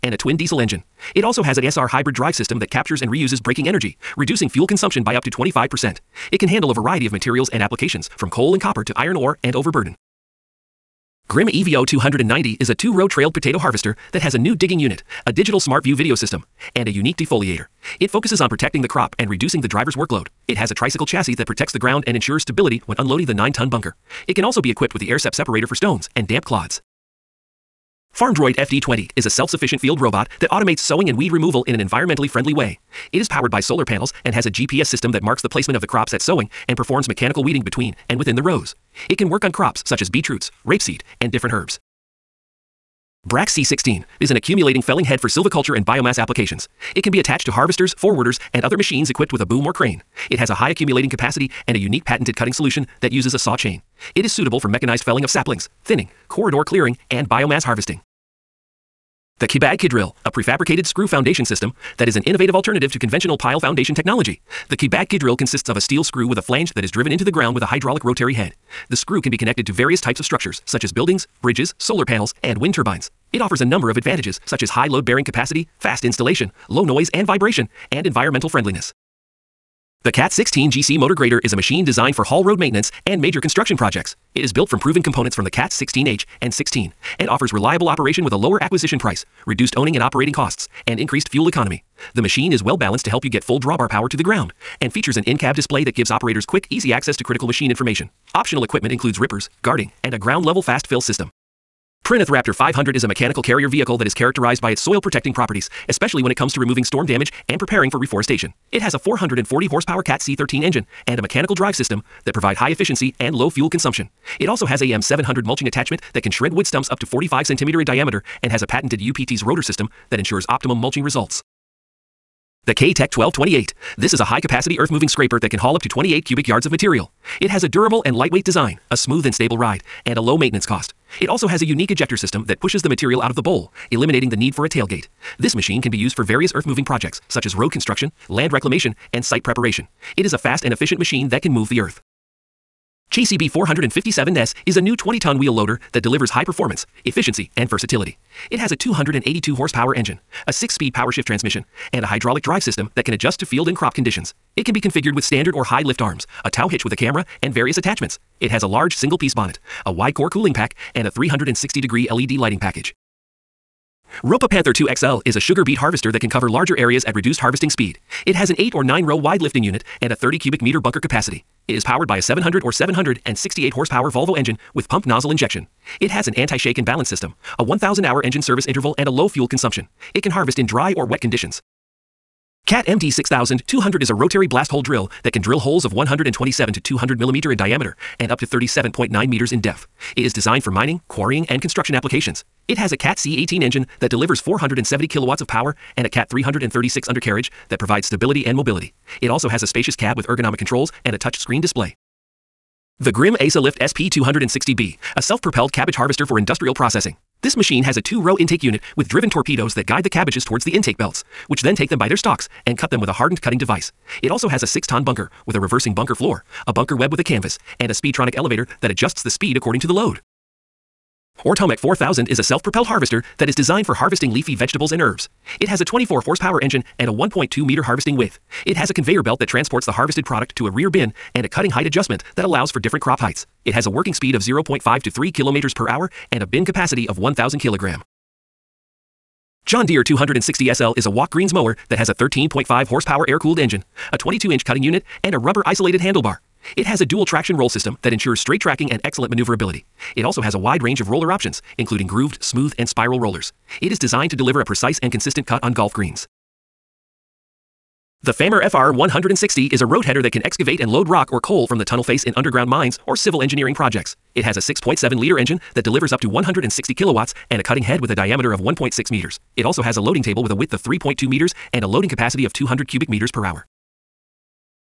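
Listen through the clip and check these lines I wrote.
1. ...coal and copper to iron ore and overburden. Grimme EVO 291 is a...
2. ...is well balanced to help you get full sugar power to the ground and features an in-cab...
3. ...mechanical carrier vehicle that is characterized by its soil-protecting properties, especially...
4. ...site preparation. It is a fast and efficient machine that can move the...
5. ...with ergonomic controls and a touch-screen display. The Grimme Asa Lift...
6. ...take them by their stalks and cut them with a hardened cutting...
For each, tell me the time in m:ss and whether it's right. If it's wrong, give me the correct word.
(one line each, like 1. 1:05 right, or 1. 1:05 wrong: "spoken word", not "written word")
1. 0:08 wrong: "290", not "291"
2. 1:32 wrong: "drawbar", not "sugar"
3. 1:43 right
4. 2:19 right
5. 3:20 right
6. 3:31 right.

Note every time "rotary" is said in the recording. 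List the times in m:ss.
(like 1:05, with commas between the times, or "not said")
1:08, 3:04.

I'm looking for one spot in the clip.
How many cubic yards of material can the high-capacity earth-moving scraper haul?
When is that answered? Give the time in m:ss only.
2:05.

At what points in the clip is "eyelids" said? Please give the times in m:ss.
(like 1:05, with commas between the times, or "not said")
not said.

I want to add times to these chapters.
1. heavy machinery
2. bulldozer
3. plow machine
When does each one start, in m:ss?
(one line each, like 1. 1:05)
1. 1:32
2. 2:45
3. 3:40.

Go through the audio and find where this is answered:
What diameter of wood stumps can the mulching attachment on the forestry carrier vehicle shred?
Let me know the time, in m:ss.
1:57.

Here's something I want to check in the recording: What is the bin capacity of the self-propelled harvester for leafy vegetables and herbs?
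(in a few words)
1,000 kilograms.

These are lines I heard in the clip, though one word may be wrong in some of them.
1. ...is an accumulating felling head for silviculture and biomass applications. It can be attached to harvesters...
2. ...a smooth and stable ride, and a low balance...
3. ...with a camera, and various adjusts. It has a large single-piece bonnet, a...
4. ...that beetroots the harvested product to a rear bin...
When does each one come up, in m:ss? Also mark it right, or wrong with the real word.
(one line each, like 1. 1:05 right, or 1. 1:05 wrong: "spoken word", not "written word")
1. 0:44 right
2. 2:08 wrong: "maintenance", not "balance"
3. 2:36 wrong: "attachments", not "adjusts"
4. 3:49 wrong: "transports", not "beetroots".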